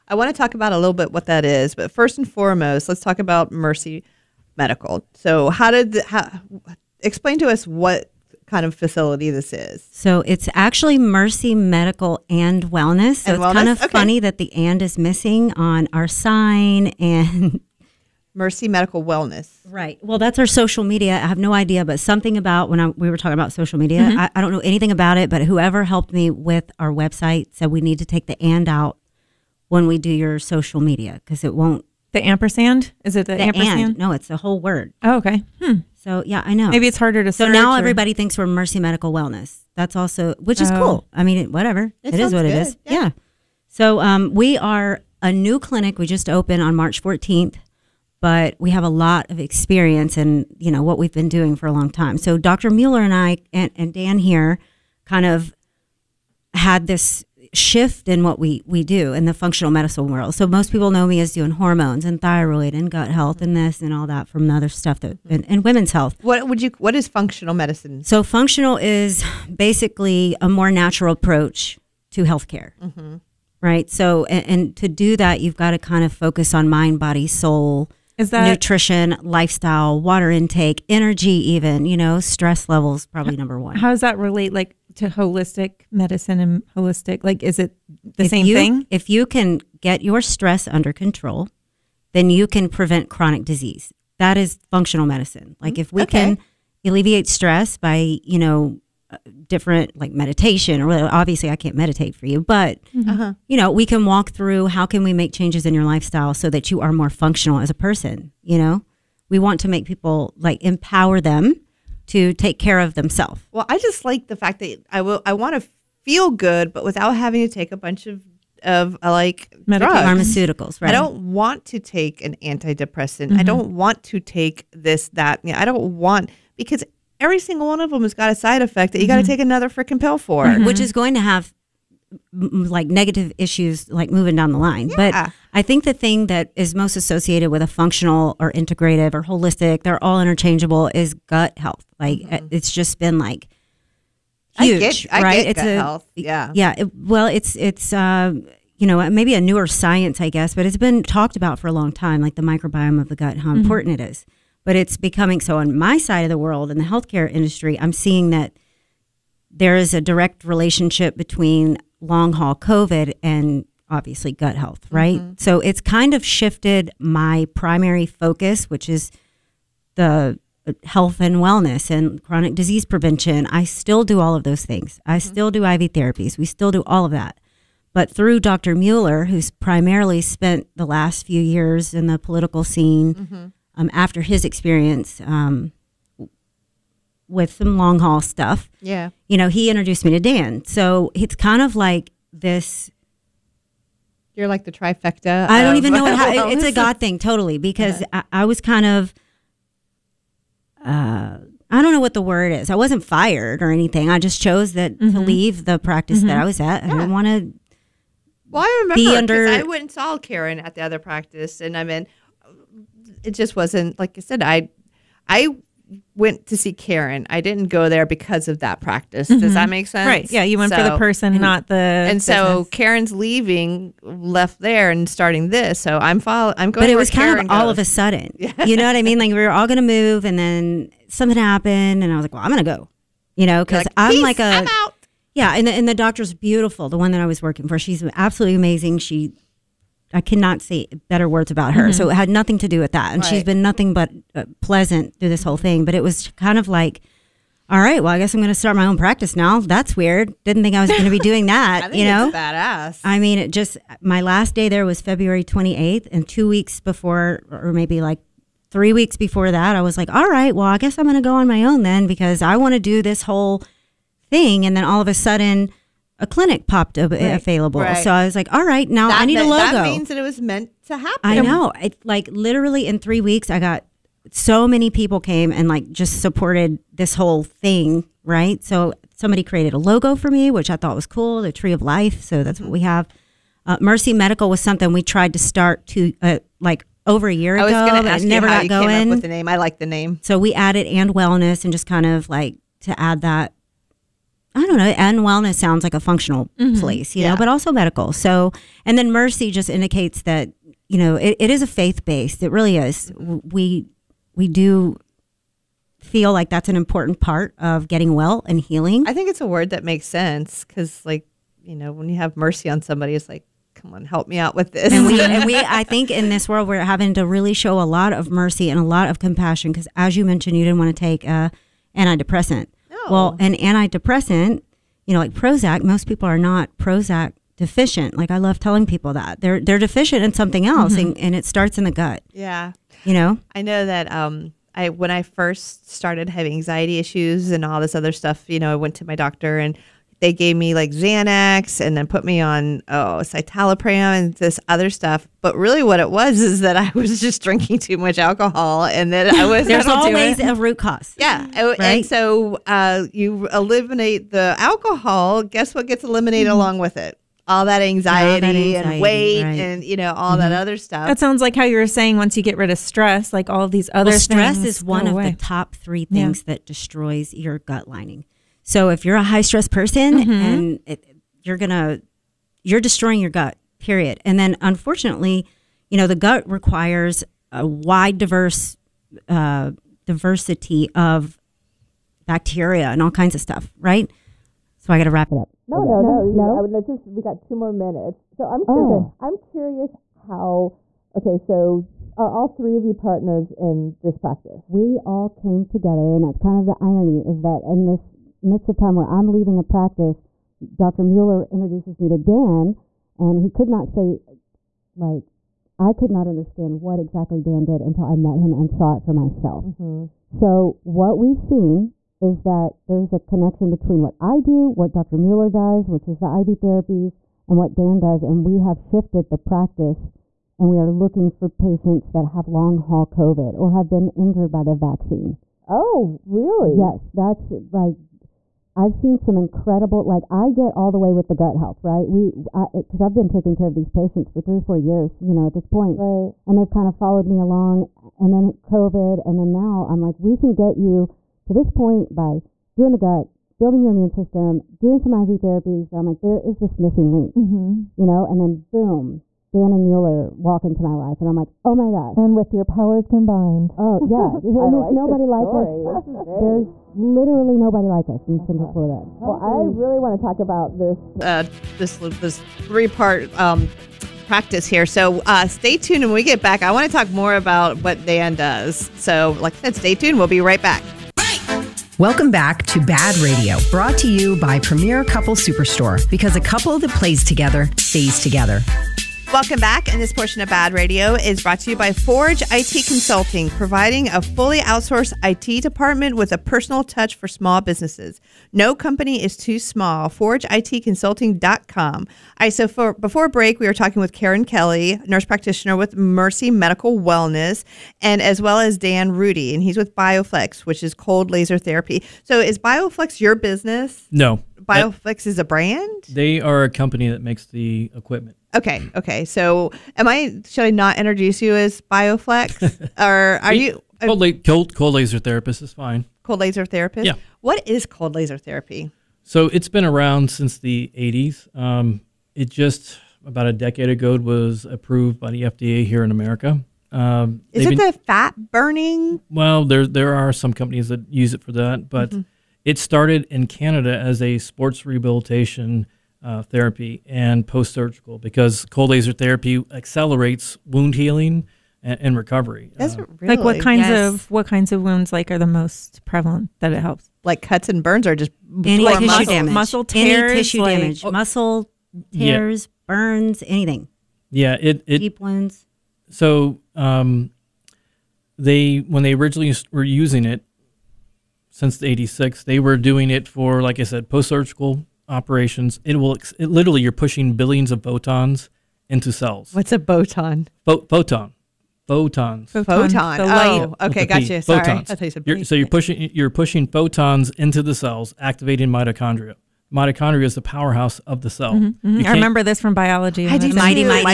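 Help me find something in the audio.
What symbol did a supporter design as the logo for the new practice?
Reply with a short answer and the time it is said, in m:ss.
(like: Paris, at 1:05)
the tree of life, at 4:41.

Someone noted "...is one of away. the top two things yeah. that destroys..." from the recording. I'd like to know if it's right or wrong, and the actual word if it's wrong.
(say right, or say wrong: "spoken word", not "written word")
wrong: "three", not "two".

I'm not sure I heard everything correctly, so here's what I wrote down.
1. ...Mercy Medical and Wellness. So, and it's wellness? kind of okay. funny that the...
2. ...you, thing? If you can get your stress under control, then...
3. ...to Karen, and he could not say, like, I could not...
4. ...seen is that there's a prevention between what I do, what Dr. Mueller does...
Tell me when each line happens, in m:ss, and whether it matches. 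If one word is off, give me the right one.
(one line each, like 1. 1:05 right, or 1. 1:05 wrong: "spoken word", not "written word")
1. 0:10 right
2. 1:28 right
3. 6:42 wrong: "Dan", not "Karen"
4. 6:51 wrong: "connection", not "prevention".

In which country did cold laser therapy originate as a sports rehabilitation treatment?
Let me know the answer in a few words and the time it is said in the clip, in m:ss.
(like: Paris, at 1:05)
Canada, at 8:53.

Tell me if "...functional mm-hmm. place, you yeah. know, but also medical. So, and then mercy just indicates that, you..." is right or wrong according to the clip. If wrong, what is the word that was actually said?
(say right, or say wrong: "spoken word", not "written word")
right.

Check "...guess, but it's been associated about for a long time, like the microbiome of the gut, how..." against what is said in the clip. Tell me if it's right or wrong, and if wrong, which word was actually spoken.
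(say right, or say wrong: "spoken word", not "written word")
wrong: "talked", not "associated".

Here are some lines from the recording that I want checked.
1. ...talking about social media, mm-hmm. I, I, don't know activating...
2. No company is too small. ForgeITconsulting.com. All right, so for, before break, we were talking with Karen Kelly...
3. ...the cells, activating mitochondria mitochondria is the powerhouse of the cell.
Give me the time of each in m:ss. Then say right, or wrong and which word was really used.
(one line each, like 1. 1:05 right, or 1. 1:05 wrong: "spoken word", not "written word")
1. 0:23 wrong: "anything", not "activating"
2. 8:08 right
3. 9:37 right.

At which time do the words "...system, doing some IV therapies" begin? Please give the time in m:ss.
7:24.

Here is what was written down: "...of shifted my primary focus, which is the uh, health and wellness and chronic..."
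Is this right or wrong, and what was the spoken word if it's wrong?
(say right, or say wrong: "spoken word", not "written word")
right.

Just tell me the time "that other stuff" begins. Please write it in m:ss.
6:00.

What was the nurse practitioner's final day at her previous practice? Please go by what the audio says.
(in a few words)
February 28th.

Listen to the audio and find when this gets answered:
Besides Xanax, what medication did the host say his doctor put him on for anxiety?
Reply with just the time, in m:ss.
5:43.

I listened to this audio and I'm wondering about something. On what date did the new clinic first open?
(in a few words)
March 14th.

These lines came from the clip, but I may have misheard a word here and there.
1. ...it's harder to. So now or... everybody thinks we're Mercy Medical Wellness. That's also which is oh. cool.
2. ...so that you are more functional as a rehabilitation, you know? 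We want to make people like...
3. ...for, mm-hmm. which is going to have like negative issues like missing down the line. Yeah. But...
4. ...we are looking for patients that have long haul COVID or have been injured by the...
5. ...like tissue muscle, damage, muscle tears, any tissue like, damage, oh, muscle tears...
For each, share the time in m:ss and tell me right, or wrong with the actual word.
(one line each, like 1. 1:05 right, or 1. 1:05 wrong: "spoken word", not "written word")
1. 0:36 right
2. 1:46 wrong: "person", not "rehabilitation"
3. 2:10 wrong: "moving", not "missing"
4. 7:00 right
5. 9:08 right.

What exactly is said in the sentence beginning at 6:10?
and it, you're gonna you're destroying your gut, period.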